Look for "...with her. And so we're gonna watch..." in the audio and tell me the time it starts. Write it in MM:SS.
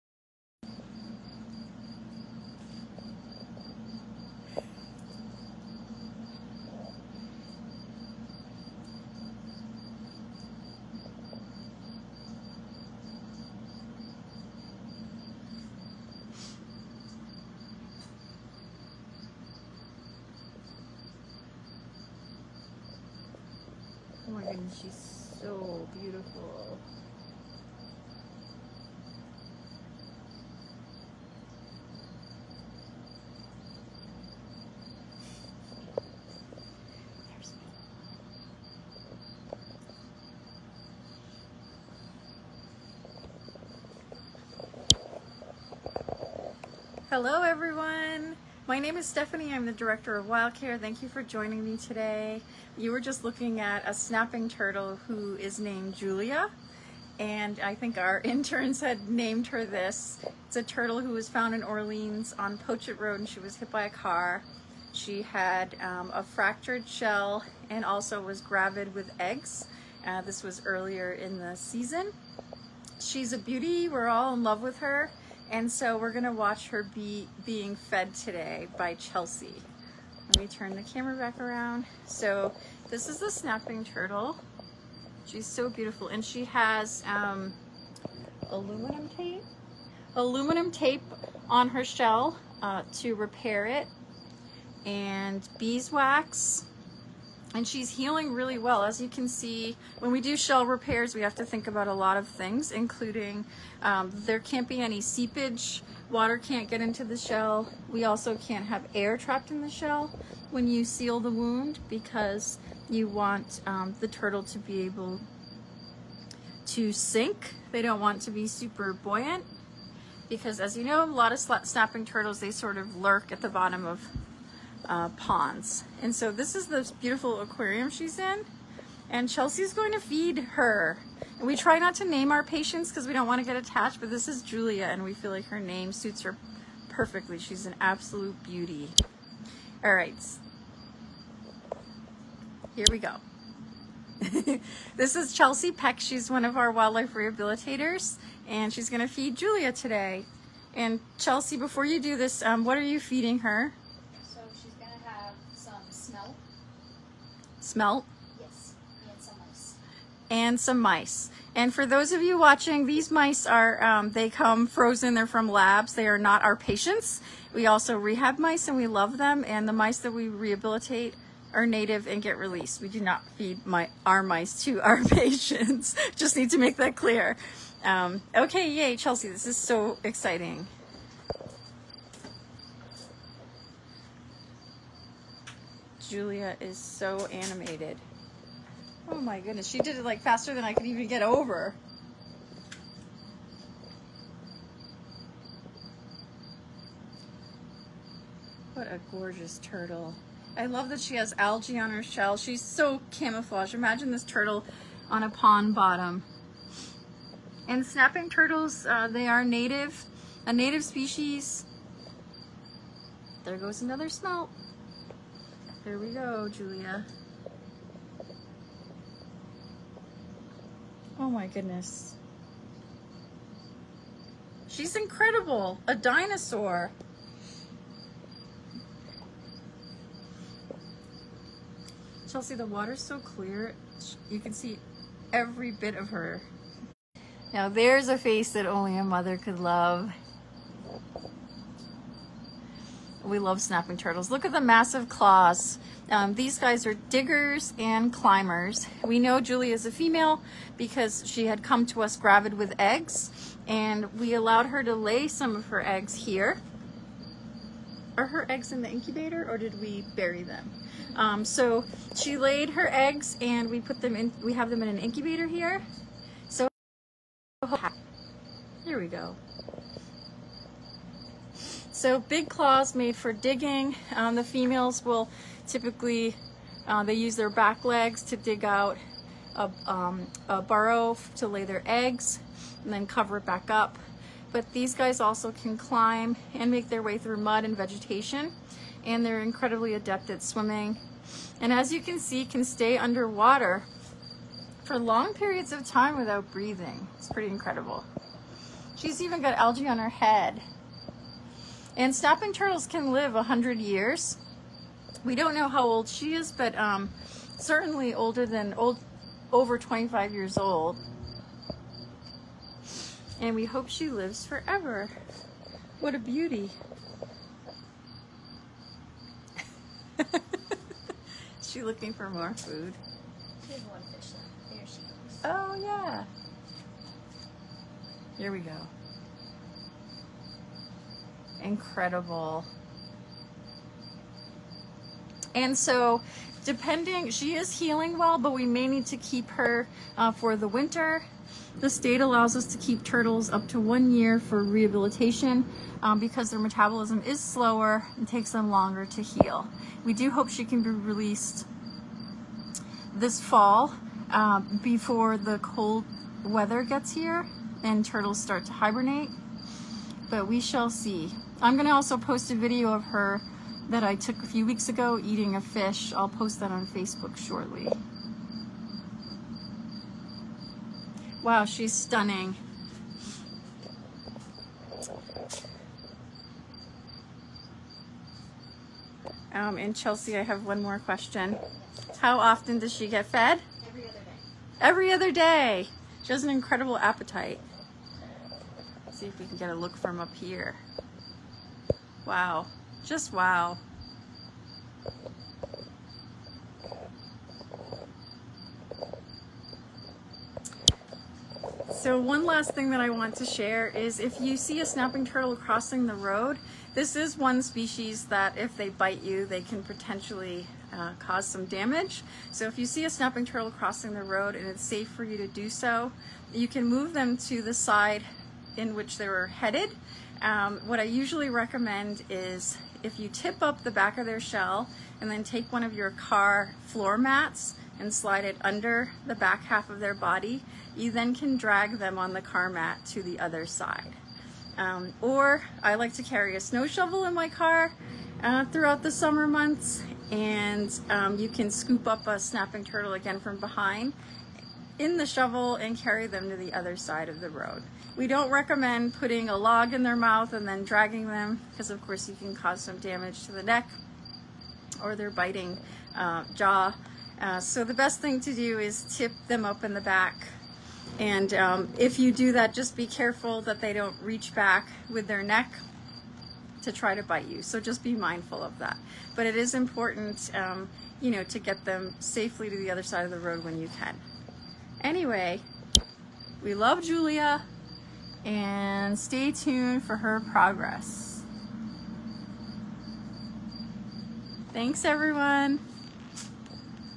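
01:14.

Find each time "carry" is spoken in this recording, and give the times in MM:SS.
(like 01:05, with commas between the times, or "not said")
07:16, 07:25.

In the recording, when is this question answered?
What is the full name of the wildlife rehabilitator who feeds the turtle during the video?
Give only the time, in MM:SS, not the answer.
02:25.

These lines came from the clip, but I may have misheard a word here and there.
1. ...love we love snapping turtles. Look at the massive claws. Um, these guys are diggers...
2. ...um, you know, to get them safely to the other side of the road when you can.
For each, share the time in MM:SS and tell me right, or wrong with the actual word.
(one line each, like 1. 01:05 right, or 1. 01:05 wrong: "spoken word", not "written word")
1. 03:59 right
2. 07:50 right.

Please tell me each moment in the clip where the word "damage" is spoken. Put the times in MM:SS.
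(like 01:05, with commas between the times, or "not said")
06:51, 07:32.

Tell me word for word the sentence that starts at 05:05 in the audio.
We don't know how old she is, but um, certainly older than old, over 25 years old.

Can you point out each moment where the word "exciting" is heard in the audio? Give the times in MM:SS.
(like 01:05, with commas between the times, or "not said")
03:00.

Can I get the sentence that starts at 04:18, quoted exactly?
Are her eggs in the incubator or did we bury them?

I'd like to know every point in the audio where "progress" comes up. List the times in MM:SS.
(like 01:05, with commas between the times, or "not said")
08:00.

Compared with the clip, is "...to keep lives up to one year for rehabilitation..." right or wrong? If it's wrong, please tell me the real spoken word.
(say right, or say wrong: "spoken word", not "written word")
wrong: "turtles", not "lives".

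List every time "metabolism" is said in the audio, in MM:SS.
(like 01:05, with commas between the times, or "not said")
05:46.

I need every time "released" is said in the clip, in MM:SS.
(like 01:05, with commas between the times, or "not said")
02:52, 05:50.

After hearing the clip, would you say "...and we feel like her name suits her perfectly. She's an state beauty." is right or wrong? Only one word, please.
wrong.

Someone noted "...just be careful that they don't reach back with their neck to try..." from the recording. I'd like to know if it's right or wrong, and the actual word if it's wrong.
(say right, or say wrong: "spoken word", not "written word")
right.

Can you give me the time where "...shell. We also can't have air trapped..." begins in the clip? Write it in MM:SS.
01:47.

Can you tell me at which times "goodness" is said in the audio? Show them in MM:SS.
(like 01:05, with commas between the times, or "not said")
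03:09, 03:41.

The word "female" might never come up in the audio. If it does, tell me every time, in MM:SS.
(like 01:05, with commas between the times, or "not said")
04:09, 04:34.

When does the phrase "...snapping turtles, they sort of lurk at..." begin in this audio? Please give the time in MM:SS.
02:01.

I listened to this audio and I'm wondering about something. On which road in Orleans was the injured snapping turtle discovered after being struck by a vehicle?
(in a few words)
Pochet Road.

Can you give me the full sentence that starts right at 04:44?
But these guys also can climb and make their way through mud and vegetation.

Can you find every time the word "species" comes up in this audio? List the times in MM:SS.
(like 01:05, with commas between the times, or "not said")
03:30, 06:47.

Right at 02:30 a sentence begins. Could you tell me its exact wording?
And Chelsea, before you do this, um, what are you feeding her?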